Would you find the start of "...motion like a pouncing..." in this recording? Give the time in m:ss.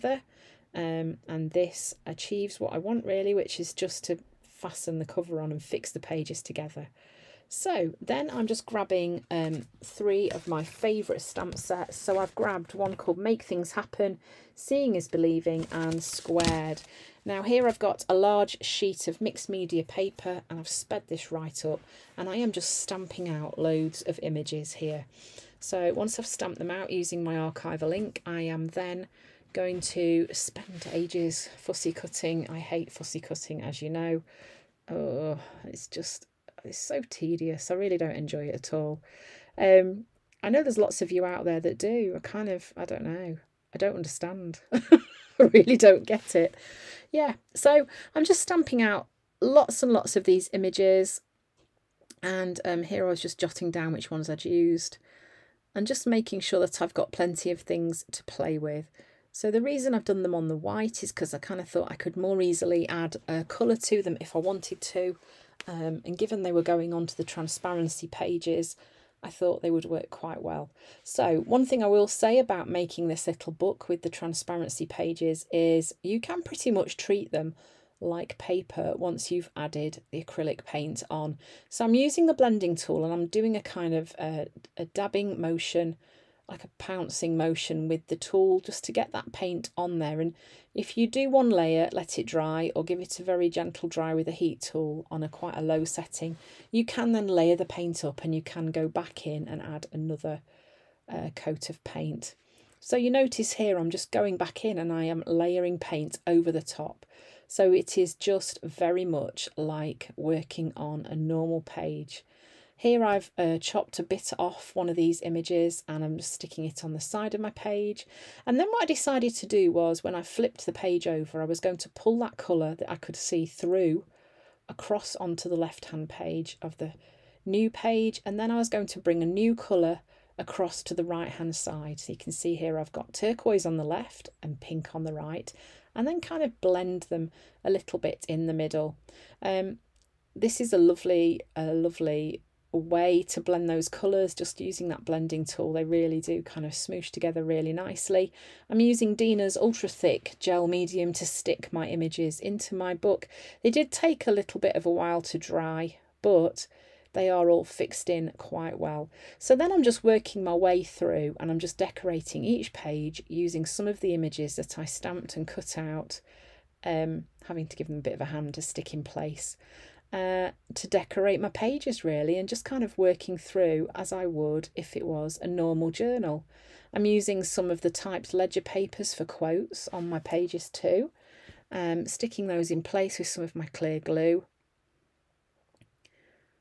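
1:25.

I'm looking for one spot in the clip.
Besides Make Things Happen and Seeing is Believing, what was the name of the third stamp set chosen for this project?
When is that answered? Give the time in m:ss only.
0:16.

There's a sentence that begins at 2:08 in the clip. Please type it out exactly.
And then I was going to bring a new colour across to the right hand side.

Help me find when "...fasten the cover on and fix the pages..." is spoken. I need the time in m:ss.
0:04.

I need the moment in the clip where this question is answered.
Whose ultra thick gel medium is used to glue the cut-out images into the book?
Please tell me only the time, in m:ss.
2:29.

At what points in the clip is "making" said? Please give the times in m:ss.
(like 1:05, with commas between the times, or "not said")
0:56, 1:12.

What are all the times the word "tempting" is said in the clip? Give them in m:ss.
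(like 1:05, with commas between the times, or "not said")
not said.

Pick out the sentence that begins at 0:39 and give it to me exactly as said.
Um, I know there's lots of you out there that do.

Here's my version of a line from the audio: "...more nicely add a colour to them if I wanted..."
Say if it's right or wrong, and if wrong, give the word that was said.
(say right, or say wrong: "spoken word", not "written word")
wrong: "easily", not "nicely".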